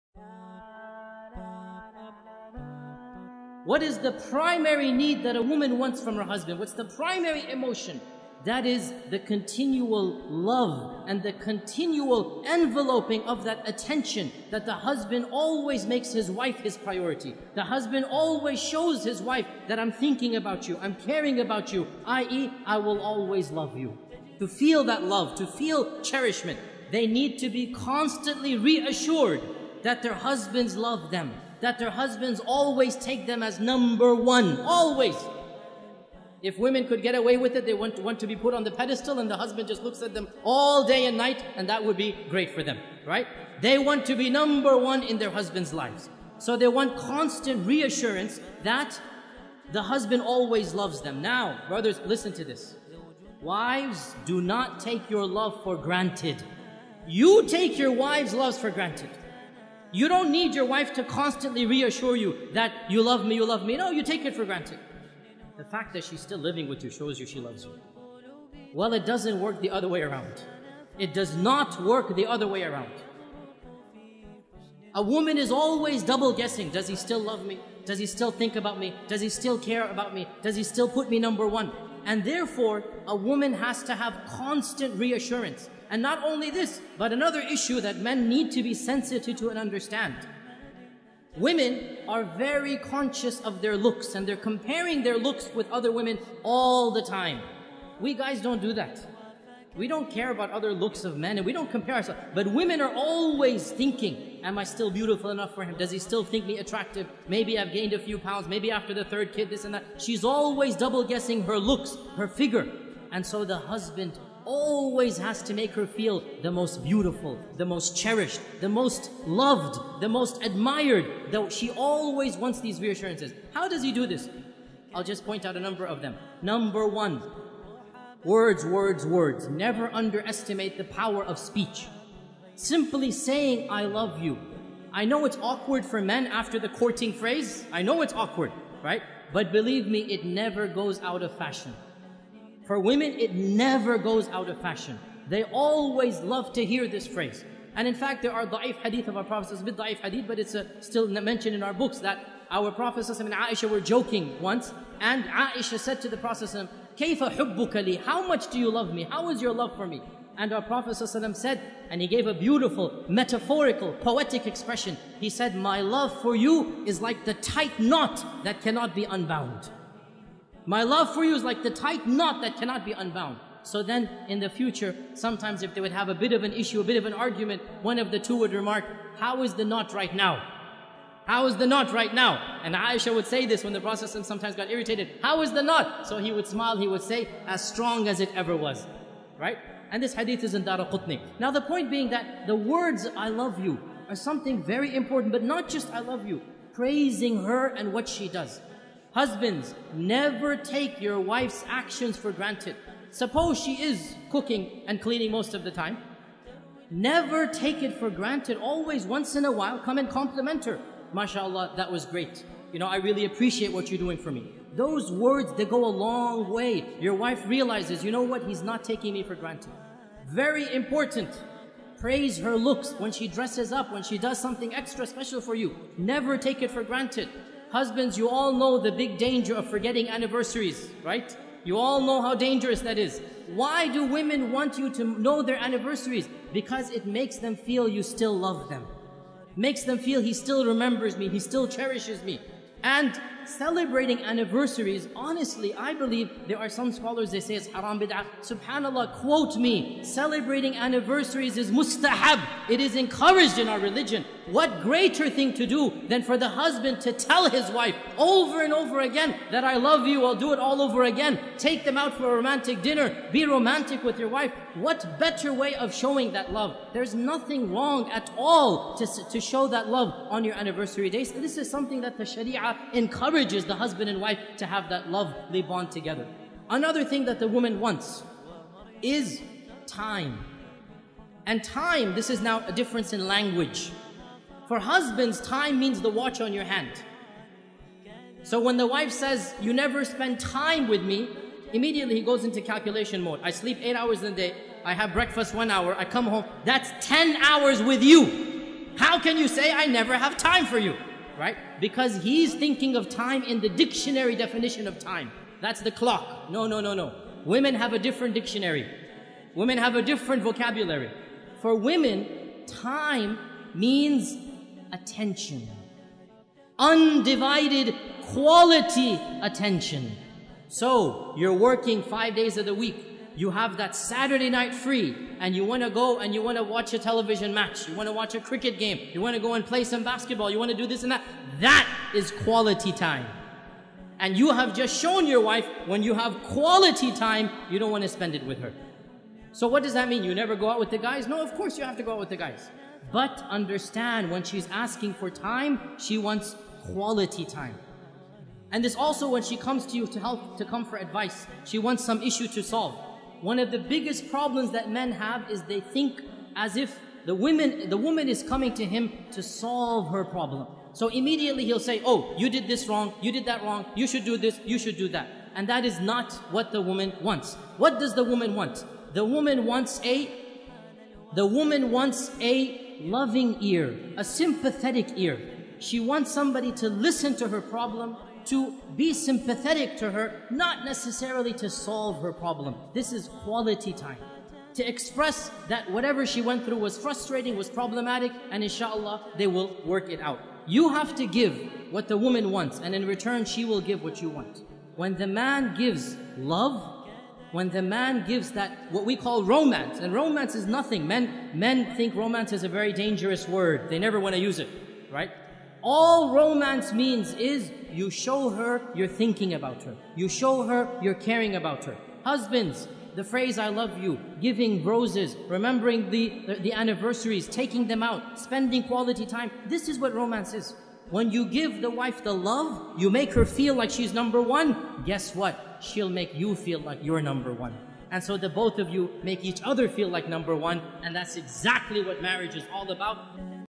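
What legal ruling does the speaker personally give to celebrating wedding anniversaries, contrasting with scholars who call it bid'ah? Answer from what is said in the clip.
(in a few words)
Mustahab.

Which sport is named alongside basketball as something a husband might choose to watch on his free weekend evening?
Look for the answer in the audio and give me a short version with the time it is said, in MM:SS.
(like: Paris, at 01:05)
Cricket, at 05:28.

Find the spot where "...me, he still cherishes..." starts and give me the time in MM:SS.
04:01.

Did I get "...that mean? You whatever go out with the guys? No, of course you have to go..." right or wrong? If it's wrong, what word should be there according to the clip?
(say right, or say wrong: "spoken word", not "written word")
wrong: "never", not "whatever".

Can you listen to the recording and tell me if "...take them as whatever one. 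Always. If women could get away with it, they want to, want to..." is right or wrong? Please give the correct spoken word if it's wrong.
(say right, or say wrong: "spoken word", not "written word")
wrong: "number", not "whatever".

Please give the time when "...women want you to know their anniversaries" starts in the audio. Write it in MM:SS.
03:54.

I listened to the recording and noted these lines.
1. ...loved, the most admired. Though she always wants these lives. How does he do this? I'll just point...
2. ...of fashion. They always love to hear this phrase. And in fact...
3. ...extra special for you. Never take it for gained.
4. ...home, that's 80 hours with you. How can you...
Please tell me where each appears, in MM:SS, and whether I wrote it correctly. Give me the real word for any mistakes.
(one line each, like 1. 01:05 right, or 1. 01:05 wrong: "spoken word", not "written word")
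1. 01:59 wrong: "reassurances", not "lives"
2. 02:24 right
3. 03:44 wrong: "granted", not "gained"
4. 04:56 wrong: "10", not "80".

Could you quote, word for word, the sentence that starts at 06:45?
all romance means is you show her you're thinking about her.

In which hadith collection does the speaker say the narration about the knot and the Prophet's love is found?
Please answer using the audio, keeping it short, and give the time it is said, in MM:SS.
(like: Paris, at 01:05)
Dara Qutni, at 03:10.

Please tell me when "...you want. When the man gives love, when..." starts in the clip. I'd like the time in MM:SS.
06:34.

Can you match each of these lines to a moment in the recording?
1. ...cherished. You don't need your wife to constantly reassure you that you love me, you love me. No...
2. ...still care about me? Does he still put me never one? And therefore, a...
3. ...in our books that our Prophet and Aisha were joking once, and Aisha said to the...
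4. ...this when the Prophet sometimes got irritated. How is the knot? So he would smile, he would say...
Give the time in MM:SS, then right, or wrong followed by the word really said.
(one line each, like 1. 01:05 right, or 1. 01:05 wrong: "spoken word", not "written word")
1. 00:58 wrong: "granted", not "cherished"
2. 01:19 wrong: "number", not "never"
3. 02:31 right
4. 03:03 right.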